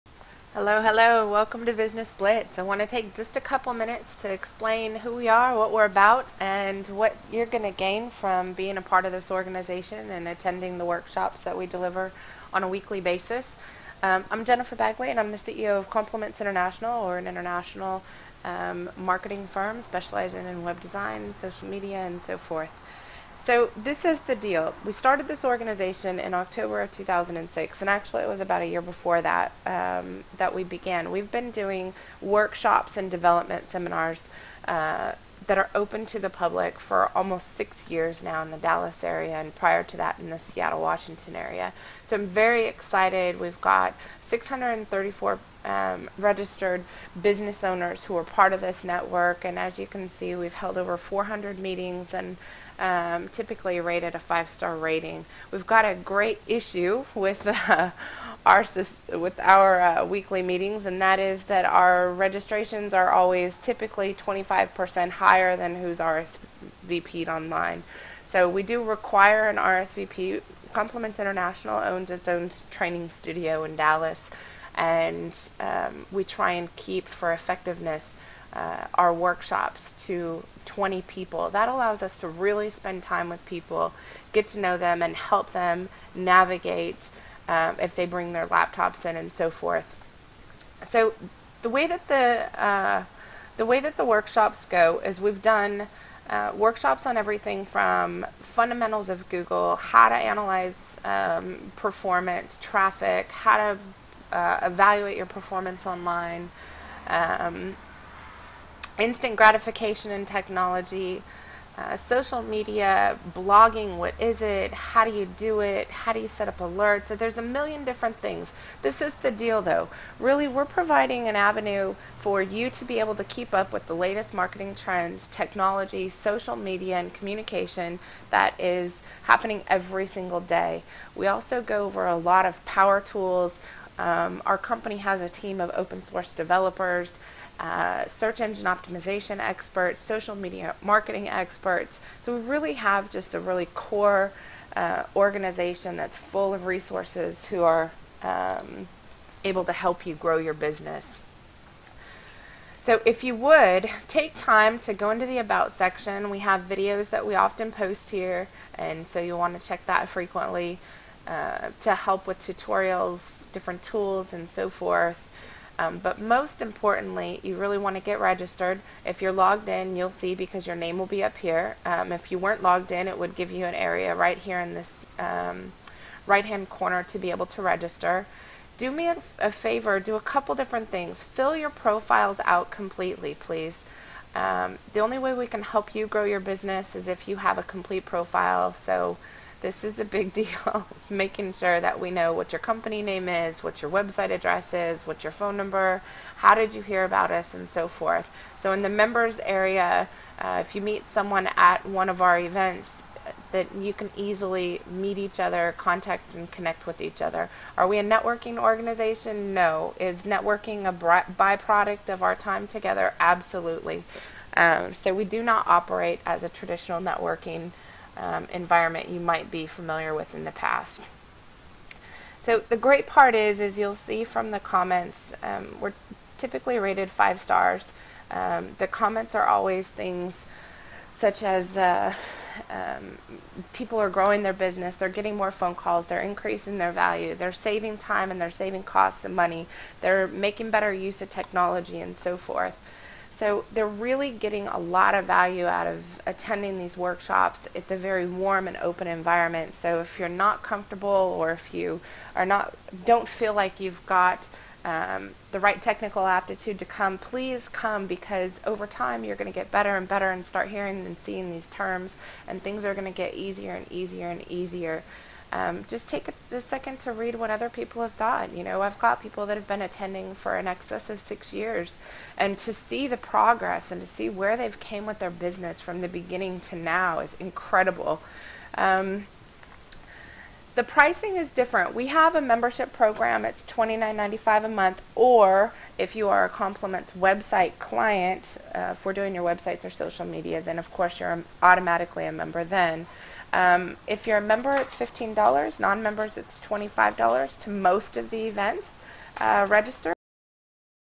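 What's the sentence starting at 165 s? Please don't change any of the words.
Um, but most importantly, you really want to get registered.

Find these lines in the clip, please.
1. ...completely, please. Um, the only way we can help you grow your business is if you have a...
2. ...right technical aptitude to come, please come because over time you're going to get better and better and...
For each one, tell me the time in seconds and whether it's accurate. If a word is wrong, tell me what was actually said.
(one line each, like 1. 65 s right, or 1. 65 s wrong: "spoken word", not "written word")
1. 182 s right
2. 255 s right.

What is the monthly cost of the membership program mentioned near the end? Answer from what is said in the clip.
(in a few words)
$29.95.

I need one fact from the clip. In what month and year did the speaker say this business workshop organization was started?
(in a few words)
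October 2006.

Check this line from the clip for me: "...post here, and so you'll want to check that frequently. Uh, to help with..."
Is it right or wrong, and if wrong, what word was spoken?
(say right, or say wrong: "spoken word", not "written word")
right.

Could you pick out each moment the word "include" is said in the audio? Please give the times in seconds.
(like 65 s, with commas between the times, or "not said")
not said.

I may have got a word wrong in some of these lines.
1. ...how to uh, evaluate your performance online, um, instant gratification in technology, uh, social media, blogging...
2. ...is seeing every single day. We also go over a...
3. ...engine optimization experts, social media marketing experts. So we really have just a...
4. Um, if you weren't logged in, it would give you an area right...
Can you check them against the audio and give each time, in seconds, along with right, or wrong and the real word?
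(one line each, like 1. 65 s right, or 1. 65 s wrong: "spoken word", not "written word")
1. 103 s right
2. 128 s wrong: "happening", not "seeing"
3. 138 s right
4. 171 s right.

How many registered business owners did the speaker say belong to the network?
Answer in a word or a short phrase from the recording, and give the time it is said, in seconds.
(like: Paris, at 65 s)
634, at 44 s.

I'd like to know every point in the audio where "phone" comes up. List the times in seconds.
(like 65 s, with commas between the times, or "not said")
195 s, 235 s.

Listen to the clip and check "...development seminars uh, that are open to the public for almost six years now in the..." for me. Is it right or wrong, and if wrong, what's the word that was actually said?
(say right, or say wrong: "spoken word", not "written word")
right.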